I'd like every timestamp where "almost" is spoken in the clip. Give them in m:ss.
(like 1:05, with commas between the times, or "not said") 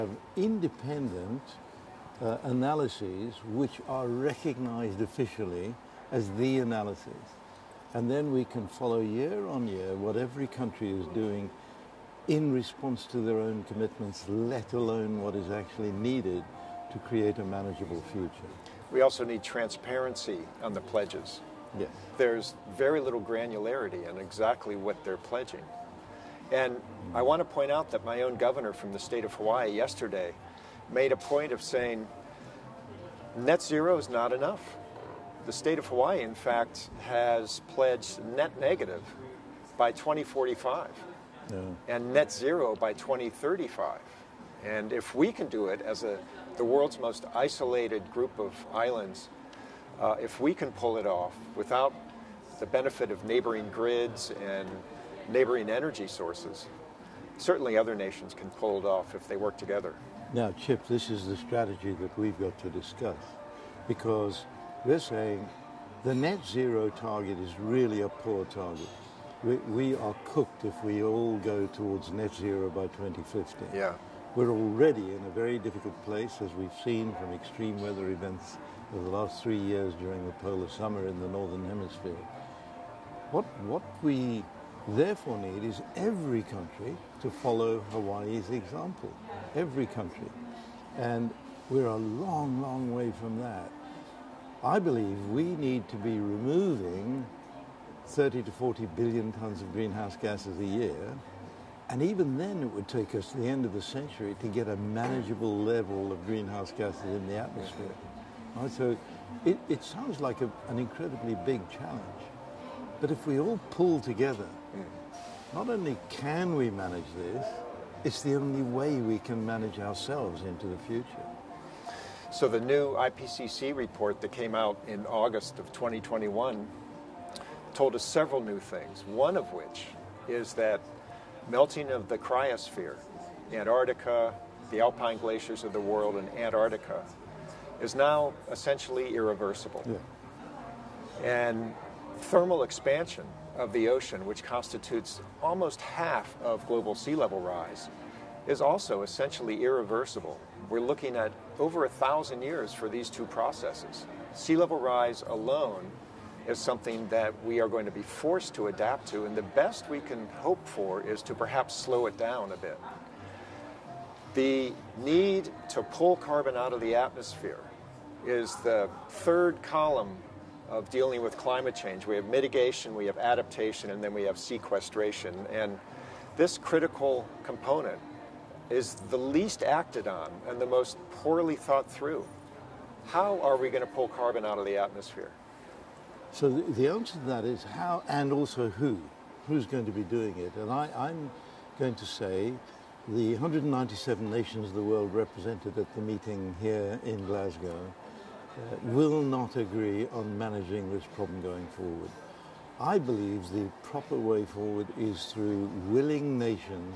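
2:25.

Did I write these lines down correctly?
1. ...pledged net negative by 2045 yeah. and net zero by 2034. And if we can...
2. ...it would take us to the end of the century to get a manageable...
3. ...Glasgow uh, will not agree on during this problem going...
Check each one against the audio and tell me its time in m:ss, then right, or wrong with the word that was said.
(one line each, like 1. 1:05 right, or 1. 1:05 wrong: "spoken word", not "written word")
1. 0:37 wrong: "2035", not "2034"
2. 1:42 right
3. 3:17 wrong: "managing", not "during".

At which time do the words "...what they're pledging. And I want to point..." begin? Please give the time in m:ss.
0:24.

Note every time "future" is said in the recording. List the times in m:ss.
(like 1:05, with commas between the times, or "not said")
0:18, 2:00.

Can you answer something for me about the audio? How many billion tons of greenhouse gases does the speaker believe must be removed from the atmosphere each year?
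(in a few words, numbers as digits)
30 to 40 billion tons.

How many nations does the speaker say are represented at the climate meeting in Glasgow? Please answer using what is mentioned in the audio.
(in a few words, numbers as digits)
197.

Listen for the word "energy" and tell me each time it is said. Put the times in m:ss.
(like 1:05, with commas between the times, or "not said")
0:55.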